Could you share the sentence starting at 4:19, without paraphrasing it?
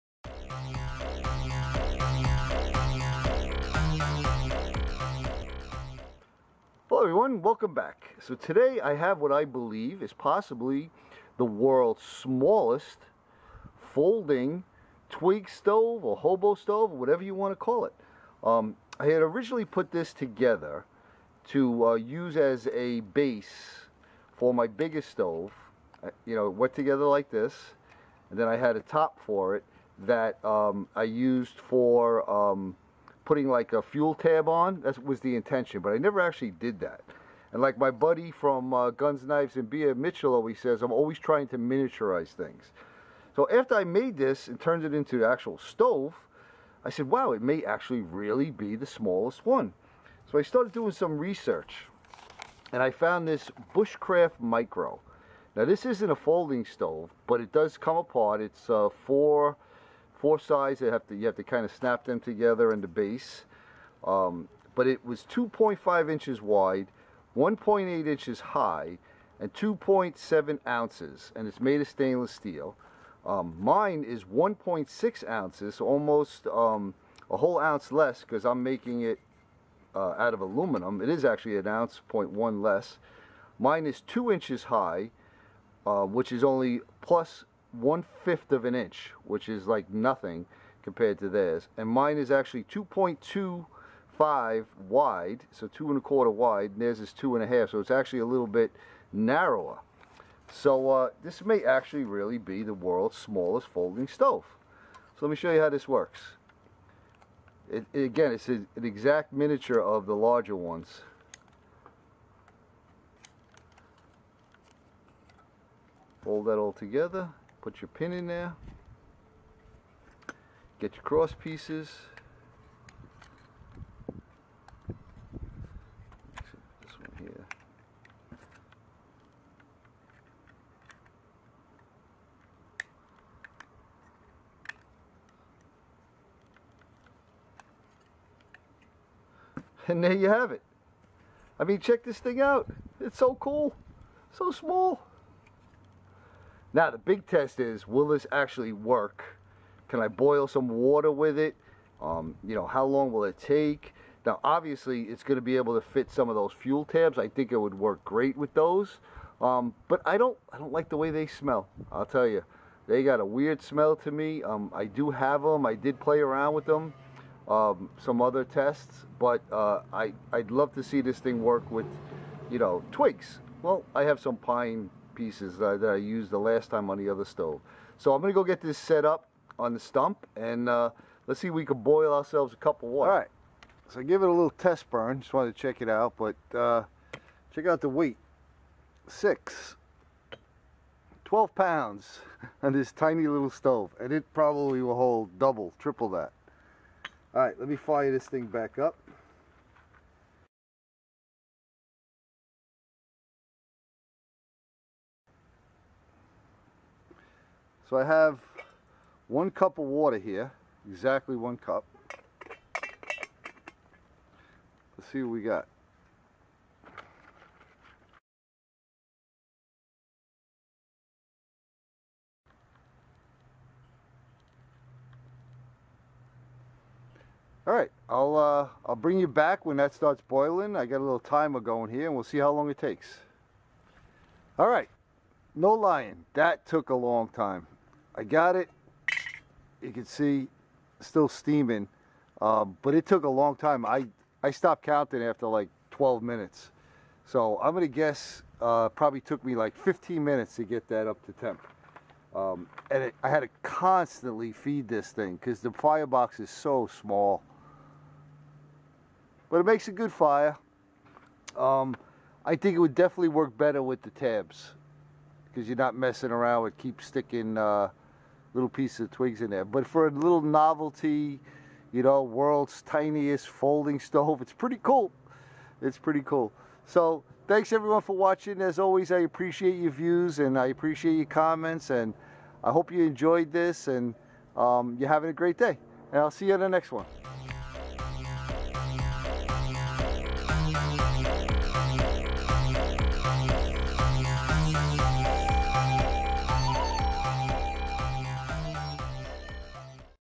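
But it makes a good fire.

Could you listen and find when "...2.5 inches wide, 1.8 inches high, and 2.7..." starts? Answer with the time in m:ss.
1:05.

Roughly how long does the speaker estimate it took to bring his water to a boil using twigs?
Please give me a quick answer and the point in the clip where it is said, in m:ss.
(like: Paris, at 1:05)
15 minutes, at 4:09.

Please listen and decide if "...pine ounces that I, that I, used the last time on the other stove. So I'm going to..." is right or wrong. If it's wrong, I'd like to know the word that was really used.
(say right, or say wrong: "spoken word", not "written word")
wrong: "pieces", not "ounces".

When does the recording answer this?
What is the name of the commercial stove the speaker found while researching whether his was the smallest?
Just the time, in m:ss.
0:53.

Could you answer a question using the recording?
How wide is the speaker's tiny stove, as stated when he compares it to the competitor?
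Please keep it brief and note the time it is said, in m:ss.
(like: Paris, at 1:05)
2.25 inches, at 1:32.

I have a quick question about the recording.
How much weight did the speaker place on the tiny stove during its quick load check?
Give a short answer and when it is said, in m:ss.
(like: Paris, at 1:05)
12 pounds, at 3:11.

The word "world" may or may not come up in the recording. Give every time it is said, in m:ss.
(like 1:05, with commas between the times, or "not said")
0:11, 1:42, 4:32.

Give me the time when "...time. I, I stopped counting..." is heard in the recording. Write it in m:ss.
4:03.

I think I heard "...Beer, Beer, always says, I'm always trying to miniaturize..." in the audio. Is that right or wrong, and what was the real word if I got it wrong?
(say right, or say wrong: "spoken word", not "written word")
wrong: "Mitchell", not "Beer".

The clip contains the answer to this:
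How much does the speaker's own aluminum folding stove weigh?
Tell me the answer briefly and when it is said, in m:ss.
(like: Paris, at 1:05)
1.6 ounces, at 1:14.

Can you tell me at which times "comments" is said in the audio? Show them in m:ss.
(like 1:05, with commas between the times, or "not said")
4:41.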